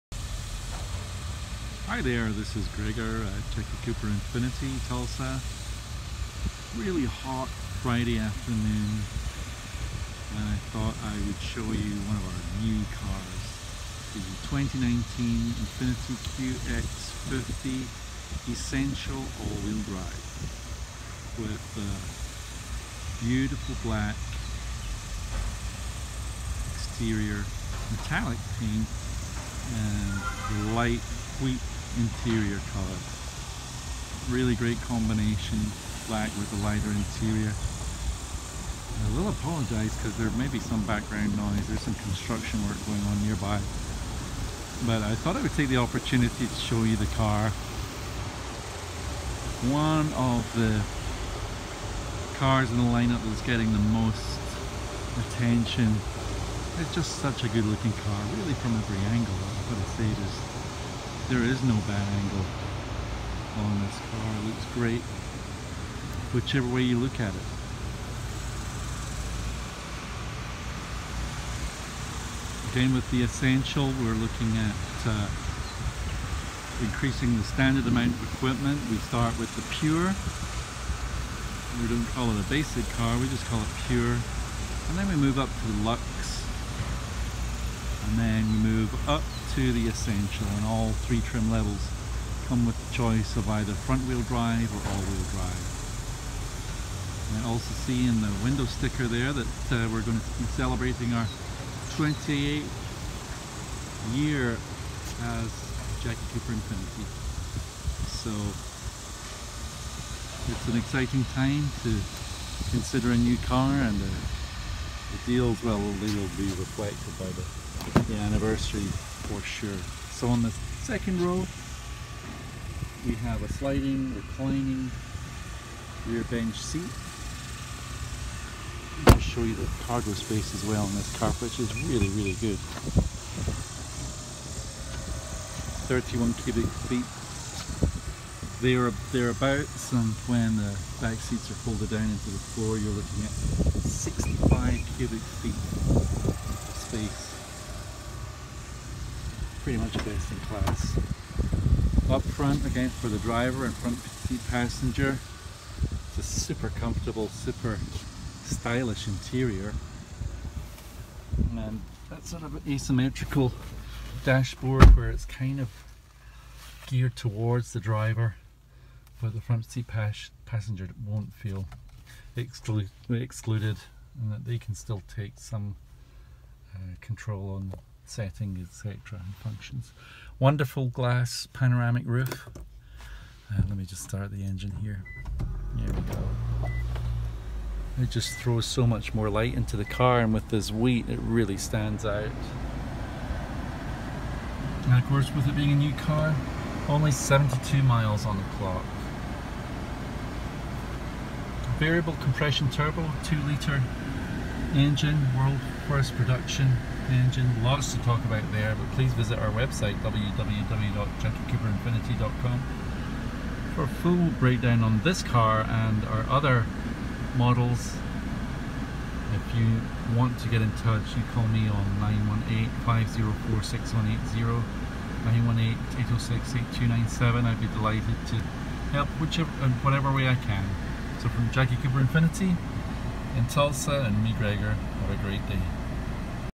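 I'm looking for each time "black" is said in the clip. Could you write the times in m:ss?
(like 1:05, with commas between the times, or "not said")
0:23, 0:36.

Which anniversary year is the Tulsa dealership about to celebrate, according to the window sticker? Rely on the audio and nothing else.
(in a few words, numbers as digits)
28th.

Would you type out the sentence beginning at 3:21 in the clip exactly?
Variable compression turbo, 2 litre engine, world first production, engine.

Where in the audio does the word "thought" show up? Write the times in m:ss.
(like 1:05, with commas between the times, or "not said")
0:10, 0:45.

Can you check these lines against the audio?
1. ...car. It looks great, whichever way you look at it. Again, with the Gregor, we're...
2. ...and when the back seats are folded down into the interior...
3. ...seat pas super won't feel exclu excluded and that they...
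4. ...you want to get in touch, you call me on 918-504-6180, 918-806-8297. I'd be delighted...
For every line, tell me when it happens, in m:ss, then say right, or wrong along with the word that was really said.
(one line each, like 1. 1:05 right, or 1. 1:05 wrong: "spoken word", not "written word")
1. 1:03 wrong: "Essential", not "Gregor"
2. 2:19 wrong: "floor", not "interior"
3. 2:49 wrong: "passenger", not "super"
4. 3:39 right.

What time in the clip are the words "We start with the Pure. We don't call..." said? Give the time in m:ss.
1:18.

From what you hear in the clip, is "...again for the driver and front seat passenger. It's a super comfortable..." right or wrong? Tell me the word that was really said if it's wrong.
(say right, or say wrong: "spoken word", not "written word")
right.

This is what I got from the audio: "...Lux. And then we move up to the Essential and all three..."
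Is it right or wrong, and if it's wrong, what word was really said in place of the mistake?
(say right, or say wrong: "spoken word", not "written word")
right.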